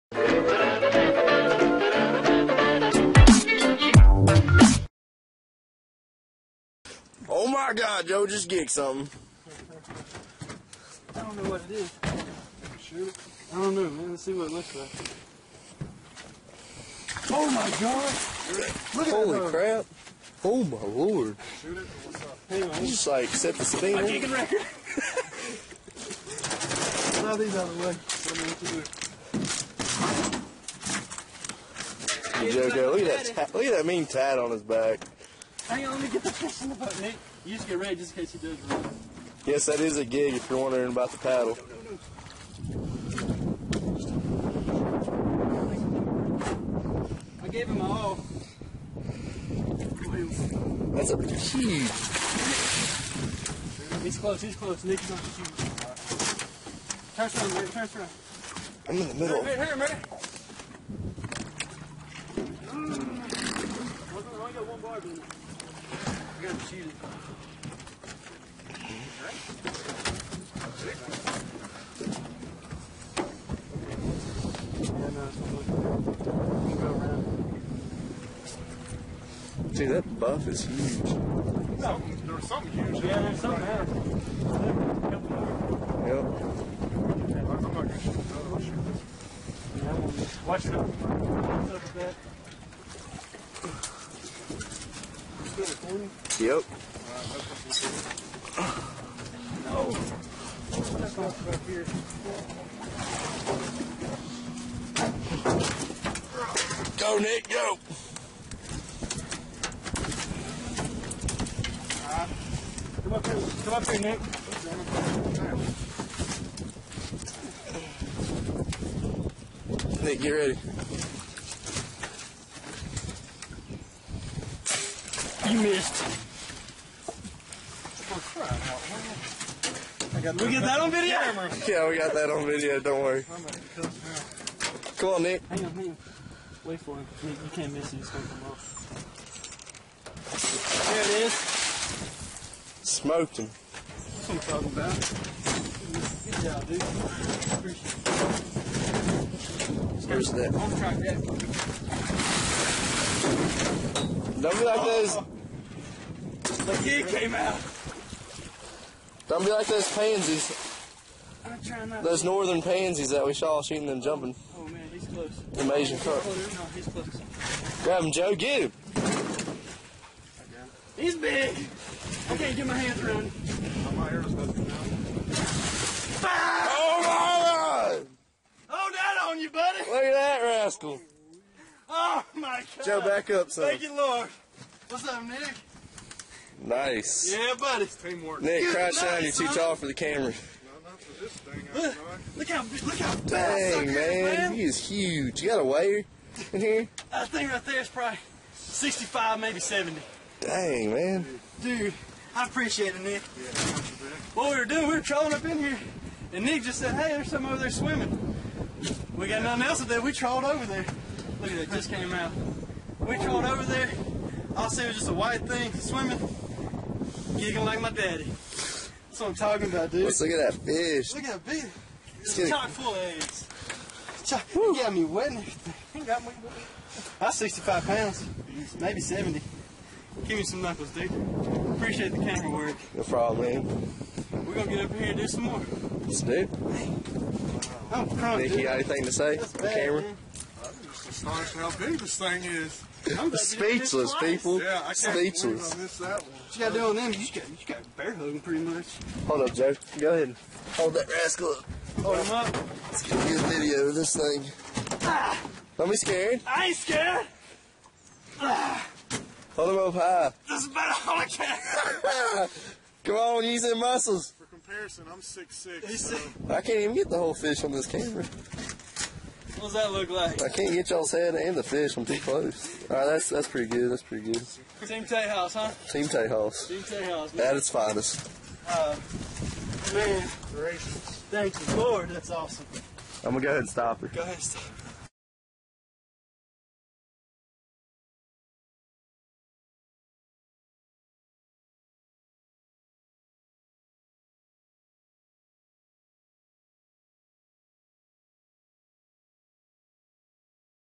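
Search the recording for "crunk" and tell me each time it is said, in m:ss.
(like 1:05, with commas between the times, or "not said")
3:58.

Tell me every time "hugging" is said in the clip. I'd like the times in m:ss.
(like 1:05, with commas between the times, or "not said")
4:08.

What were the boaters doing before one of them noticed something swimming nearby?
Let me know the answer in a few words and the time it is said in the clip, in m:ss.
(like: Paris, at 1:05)
trolling, at 3:25.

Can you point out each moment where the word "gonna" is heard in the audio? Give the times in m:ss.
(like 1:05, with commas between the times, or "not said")
2:18, 3:54, 4:43.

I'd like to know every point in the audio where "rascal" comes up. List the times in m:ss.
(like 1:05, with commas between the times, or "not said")
3:00, 4:11.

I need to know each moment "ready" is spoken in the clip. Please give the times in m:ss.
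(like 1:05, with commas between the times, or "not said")
0:37, 2:00.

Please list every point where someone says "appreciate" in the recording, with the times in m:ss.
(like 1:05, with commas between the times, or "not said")
3:22, 3:51.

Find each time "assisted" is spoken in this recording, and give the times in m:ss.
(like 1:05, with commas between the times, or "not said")
not said.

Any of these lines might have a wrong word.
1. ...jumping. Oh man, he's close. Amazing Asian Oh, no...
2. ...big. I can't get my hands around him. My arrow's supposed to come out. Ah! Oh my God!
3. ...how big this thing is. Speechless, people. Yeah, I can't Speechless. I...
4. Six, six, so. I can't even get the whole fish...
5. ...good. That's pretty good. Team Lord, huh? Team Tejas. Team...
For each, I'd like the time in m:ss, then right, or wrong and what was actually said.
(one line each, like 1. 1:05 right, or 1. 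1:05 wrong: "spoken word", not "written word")
1. 2:43 right
2. 2:51 right
3. 4:01 right
4. 4:25 right
5. 4:33 wrong: "Tejas", not "Lord".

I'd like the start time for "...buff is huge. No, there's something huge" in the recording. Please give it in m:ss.
1:20.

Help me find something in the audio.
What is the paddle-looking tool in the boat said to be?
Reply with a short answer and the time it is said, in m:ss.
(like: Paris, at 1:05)
gig, at 0:40.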